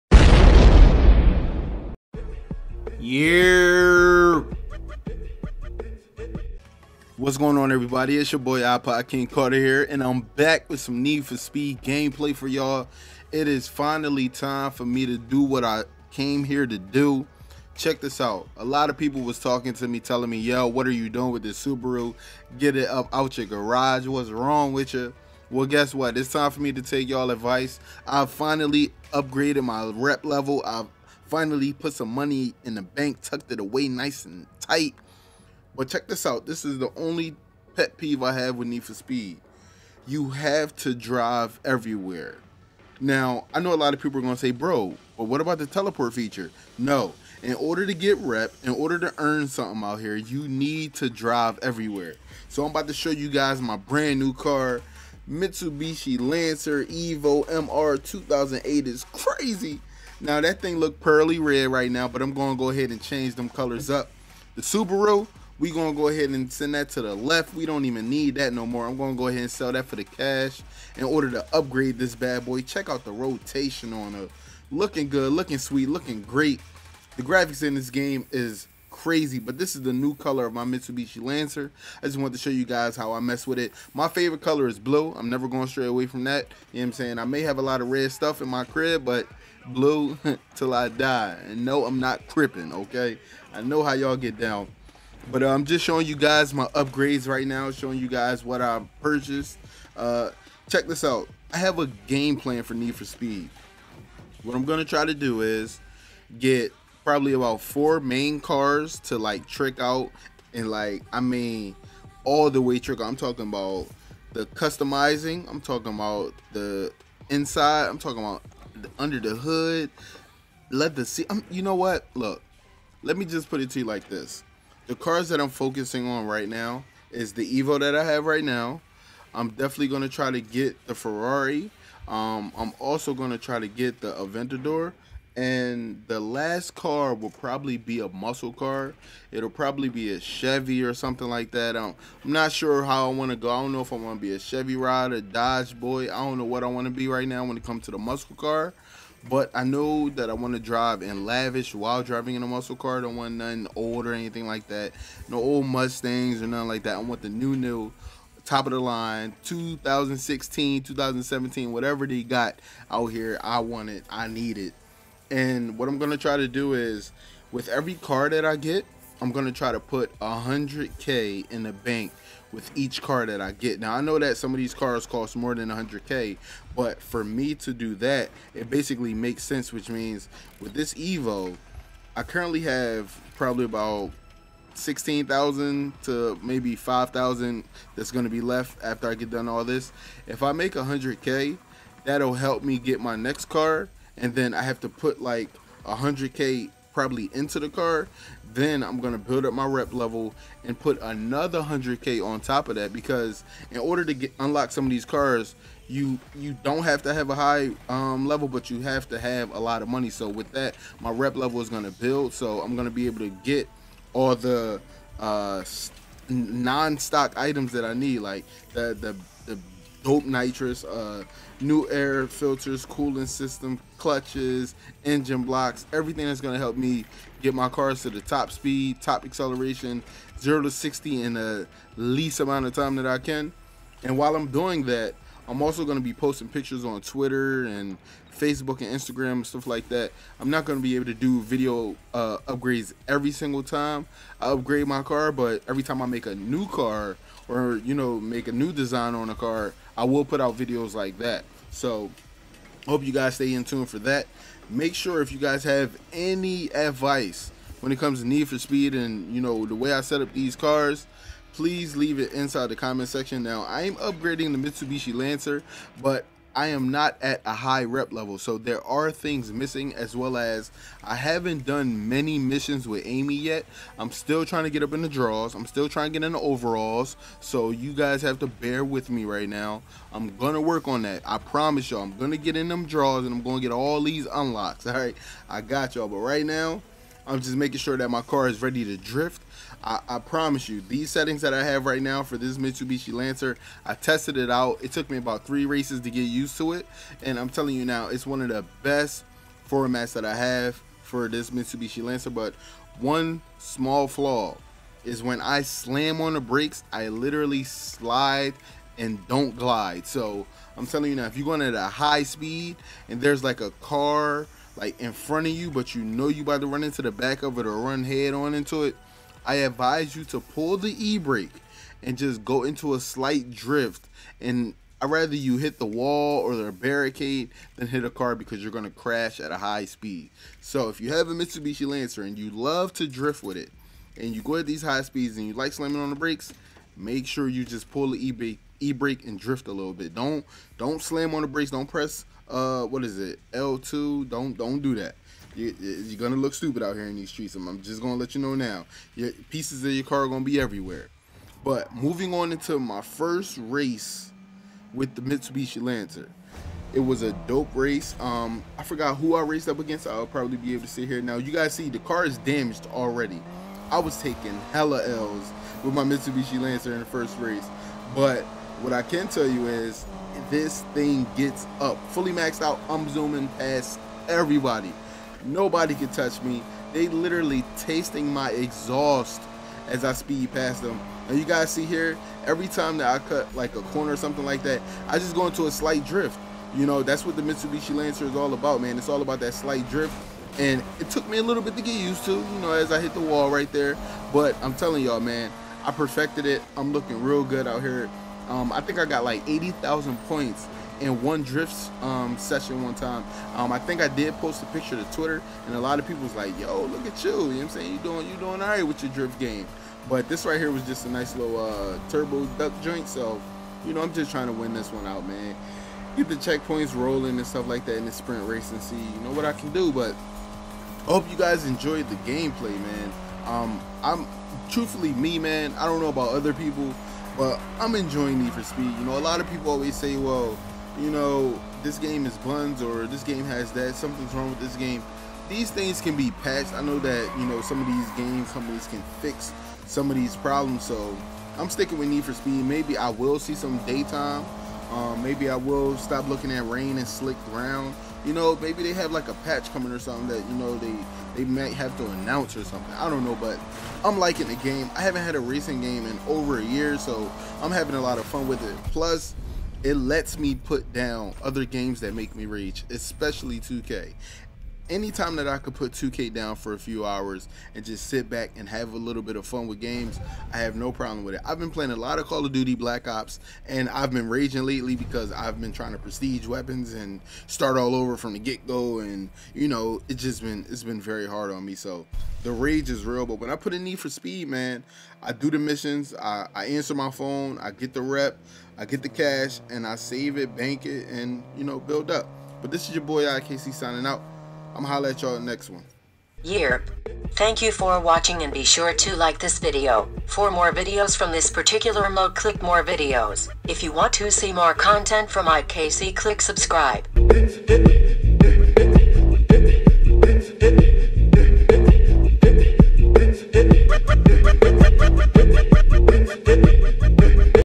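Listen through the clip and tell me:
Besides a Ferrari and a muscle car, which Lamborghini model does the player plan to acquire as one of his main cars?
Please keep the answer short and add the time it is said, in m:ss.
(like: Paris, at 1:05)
Aventador, at 2:14.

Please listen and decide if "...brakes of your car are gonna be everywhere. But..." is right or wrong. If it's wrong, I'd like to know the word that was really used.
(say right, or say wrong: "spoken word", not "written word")
wrong: "pieces", not "brakes".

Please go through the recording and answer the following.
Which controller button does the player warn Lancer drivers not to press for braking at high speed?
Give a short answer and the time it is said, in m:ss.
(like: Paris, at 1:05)
L2, at 5:43.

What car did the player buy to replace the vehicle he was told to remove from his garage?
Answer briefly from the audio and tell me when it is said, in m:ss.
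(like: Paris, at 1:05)
Mitsubishi Lancer Evo MR, at 0:55.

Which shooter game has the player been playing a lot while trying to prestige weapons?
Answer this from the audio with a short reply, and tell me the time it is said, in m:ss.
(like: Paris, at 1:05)
Call of Duty Black Ops, at 7:52.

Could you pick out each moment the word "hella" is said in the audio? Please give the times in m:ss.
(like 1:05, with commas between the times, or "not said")
6:04.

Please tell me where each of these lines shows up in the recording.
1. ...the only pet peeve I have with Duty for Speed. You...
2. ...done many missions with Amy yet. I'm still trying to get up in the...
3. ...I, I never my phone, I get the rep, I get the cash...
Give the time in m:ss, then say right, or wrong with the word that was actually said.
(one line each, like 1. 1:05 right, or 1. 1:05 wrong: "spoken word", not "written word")
1. 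0:36 wrong: "Need", not "Duty"
2. 4:31 right
3. 8:06 wrong: "answer", not "never".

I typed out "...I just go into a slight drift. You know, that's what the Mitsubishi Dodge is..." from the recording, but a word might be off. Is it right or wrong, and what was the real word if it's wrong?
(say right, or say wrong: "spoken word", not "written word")
wrong: "Lancer", not "Dodge".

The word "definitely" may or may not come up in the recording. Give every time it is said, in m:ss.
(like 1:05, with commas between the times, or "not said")
2:09.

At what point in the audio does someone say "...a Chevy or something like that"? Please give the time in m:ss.
2:20.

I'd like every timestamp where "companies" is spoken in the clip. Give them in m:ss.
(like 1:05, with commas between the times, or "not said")
7:18.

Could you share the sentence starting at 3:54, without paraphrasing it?
And while I'm doing that, I'm also going to be posting pictures on Twitter and Facebook and Instagram and stuff like that.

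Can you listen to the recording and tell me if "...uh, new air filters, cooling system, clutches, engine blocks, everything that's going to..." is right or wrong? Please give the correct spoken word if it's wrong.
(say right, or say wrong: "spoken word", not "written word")
right.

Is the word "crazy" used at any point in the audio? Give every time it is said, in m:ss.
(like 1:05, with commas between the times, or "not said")
0:59, 1:18.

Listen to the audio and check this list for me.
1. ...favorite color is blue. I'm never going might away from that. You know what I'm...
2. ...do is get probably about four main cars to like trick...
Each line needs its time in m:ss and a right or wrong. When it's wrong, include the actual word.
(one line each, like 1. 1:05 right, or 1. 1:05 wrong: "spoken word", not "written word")
1. 1:24 wrong: "straight", not "might"
2. 1:45 right.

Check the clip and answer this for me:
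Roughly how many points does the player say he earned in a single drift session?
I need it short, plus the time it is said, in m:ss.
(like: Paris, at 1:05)
80,000, at 6:39.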